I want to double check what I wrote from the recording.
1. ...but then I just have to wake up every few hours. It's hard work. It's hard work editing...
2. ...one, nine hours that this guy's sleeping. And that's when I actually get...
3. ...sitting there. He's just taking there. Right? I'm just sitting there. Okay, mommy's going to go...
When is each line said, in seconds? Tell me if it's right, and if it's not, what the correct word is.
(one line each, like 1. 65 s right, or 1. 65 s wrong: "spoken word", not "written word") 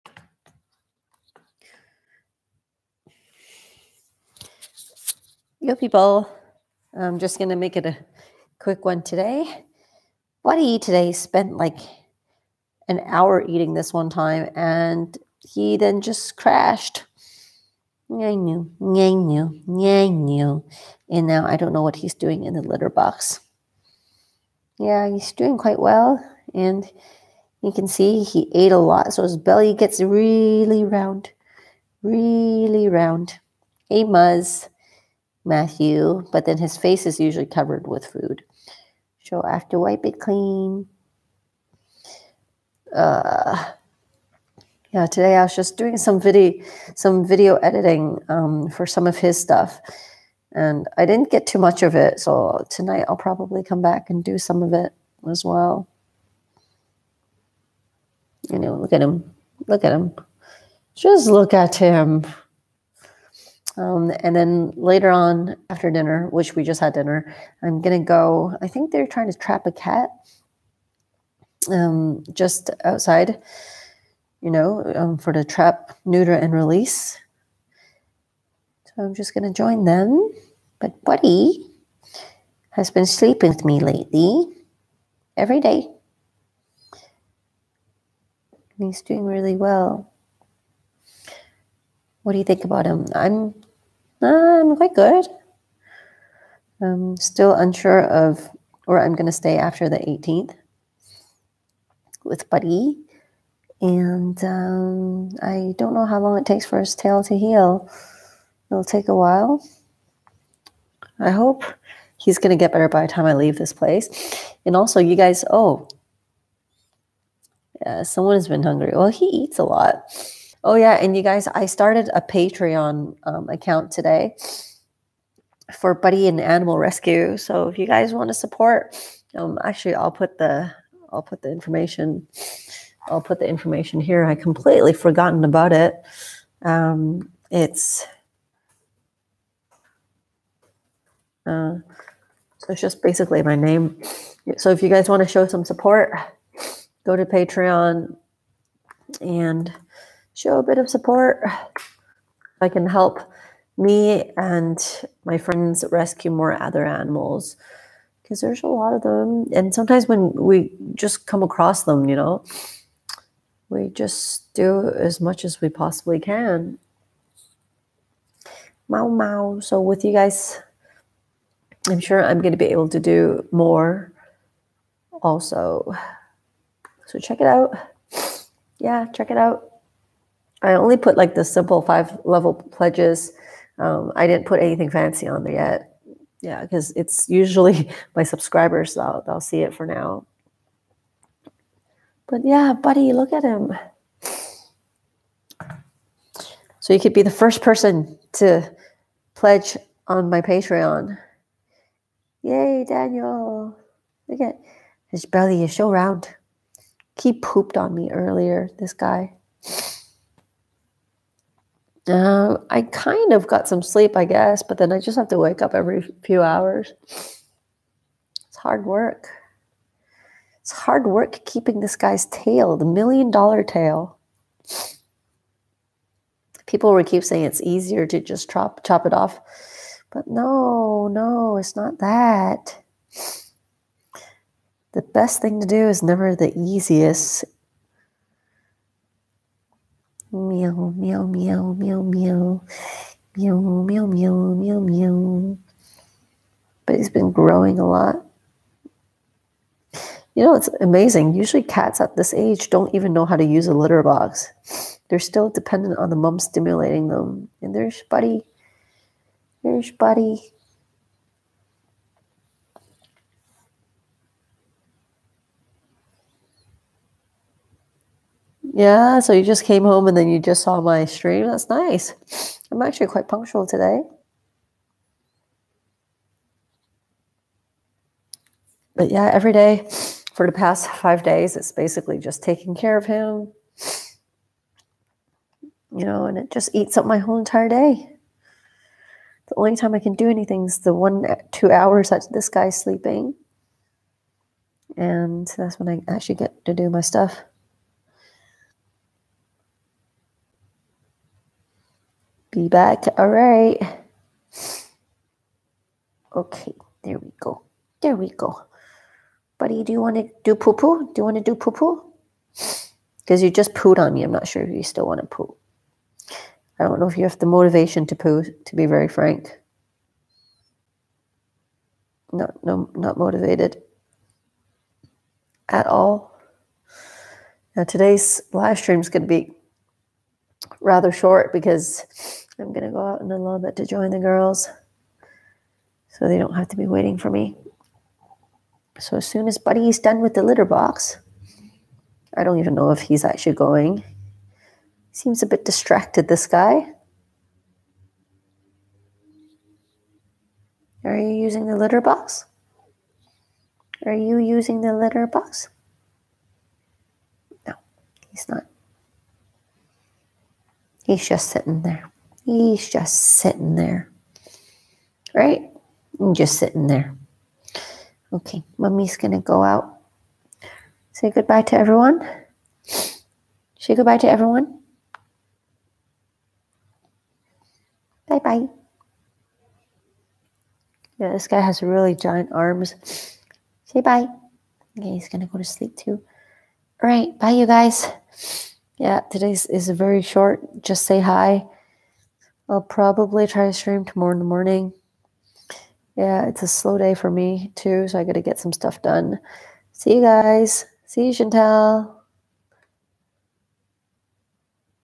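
1. 214 s wrong: "keeping", not "editing"
2. 290 s wrong: "two", not "nine"
3. 361 s wrong: "sitting", not "taking".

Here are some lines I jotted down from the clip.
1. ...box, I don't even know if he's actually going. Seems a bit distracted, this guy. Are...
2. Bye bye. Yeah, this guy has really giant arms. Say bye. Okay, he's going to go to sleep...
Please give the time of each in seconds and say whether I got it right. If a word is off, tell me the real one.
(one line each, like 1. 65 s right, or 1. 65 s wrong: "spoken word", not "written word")
1. 340 s right
2. 378 s right.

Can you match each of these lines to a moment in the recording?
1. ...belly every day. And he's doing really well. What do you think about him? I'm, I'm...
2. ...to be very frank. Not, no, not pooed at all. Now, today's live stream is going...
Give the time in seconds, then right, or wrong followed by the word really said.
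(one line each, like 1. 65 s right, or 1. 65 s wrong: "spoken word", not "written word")
1. 83 s wrong: "lately", not "belly"
2. 318 s wrong: "motivated", not "pooed".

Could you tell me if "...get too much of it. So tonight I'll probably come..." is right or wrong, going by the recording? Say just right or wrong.
right.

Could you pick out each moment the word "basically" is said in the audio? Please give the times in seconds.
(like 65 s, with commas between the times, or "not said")
143 s, 281 s.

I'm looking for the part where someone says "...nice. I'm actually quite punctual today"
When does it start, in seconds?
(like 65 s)
271 s.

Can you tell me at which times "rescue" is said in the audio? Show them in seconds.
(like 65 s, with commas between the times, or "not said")
126 s, 155 s.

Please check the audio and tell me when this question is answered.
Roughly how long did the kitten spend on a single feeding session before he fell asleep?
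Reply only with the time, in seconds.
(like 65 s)
11 s.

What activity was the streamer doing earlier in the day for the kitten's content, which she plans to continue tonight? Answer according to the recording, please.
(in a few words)
video editing.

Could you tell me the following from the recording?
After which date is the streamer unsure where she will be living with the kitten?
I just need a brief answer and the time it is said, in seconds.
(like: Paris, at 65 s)
the 18th, at 99 s.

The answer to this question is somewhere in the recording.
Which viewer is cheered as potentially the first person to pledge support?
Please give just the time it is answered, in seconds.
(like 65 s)
202 s.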